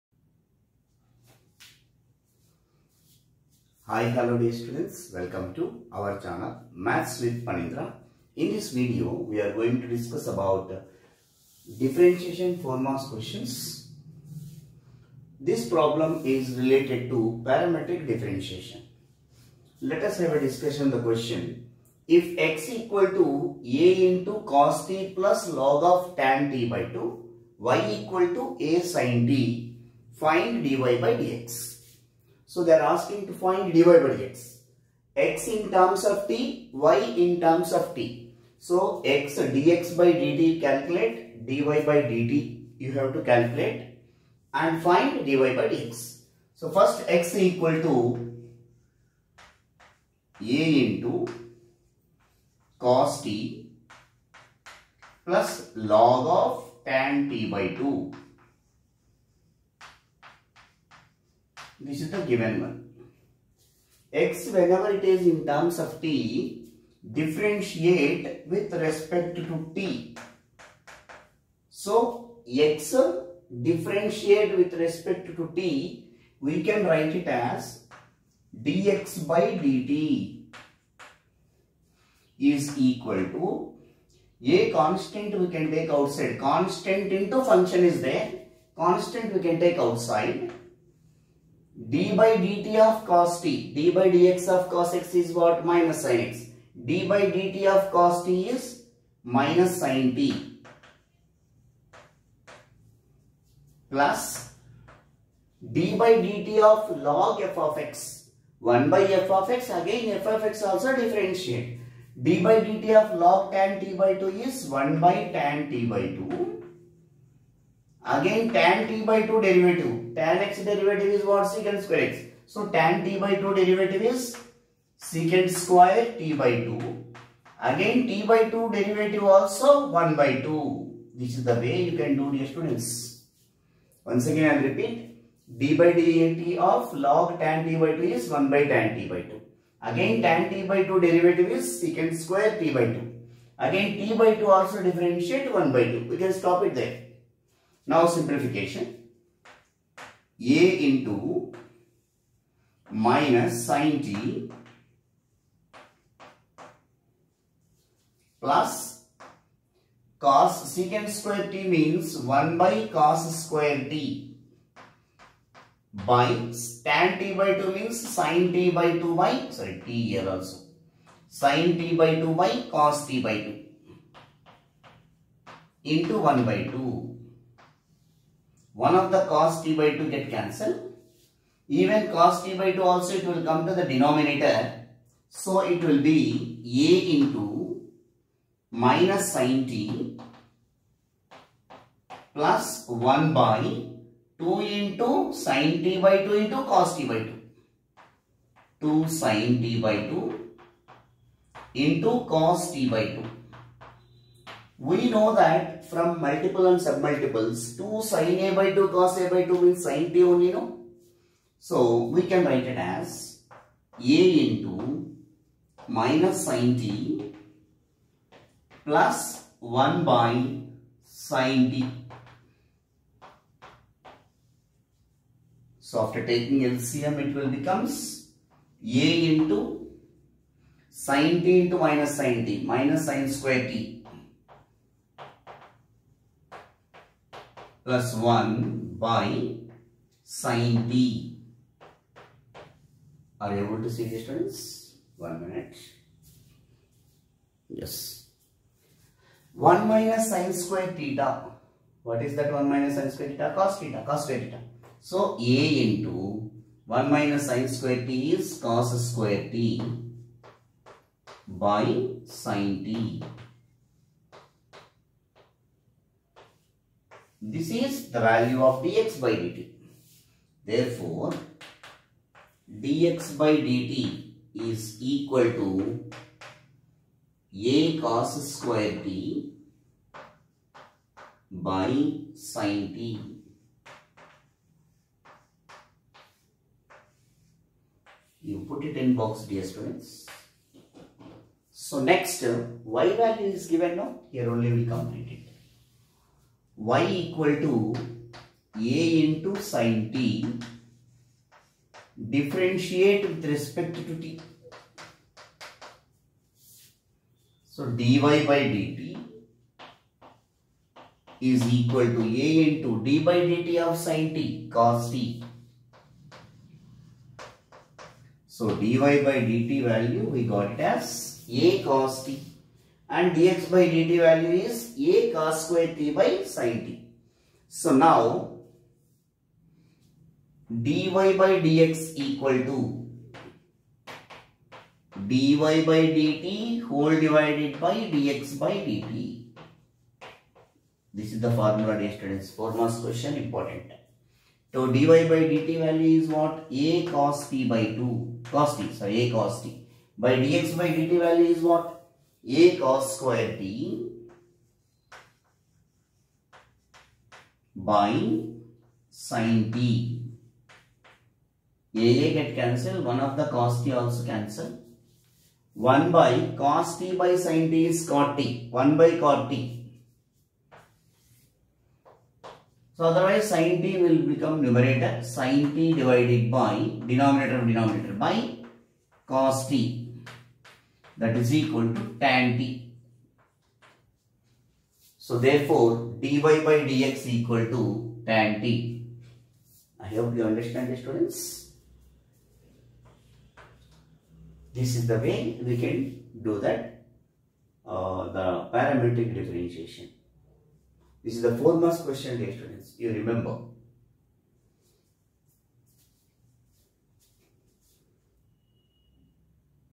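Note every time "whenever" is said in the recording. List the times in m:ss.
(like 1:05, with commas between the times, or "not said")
1:04.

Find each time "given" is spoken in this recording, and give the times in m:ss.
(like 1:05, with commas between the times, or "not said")
1:02, 4:53.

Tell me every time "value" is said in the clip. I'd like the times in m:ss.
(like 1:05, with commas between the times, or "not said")
4:28, 4:53, 5:19, 5:24, 5:45, 5:51.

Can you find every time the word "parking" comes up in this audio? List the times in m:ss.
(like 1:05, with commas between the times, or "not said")
not said.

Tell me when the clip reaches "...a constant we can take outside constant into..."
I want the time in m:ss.
1:24.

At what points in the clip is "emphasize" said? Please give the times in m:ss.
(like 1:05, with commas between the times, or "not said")
not said.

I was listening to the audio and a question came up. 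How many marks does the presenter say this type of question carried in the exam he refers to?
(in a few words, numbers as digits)
4.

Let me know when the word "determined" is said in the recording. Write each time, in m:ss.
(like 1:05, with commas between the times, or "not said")
not said.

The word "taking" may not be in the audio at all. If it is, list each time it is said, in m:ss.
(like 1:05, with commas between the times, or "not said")
3:46.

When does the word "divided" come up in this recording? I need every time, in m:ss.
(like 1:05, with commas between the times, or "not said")
5:37, 6:16.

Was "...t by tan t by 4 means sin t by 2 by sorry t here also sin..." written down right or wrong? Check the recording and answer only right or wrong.
wrong.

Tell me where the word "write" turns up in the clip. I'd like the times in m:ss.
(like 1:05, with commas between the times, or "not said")
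1:16, 3:32.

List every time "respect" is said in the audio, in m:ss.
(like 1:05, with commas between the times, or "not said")
1:08, 1:14, 5:03.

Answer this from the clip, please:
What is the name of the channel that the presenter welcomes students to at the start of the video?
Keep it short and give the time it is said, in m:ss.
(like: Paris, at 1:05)
Maths with Phaneendra, at 0:06.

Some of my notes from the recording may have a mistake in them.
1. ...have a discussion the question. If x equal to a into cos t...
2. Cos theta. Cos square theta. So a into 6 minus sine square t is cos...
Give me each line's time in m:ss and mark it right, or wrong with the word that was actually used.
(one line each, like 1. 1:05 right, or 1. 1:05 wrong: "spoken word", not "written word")
1. 0:20 right
2. 4:13 wrong: "1", not "6".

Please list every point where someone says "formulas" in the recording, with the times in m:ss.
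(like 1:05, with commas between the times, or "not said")
0:12, 5:41.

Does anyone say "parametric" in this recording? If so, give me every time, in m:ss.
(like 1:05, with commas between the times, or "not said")
0:17, 6:38.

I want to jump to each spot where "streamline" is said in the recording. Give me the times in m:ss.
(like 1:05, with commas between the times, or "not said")
not said.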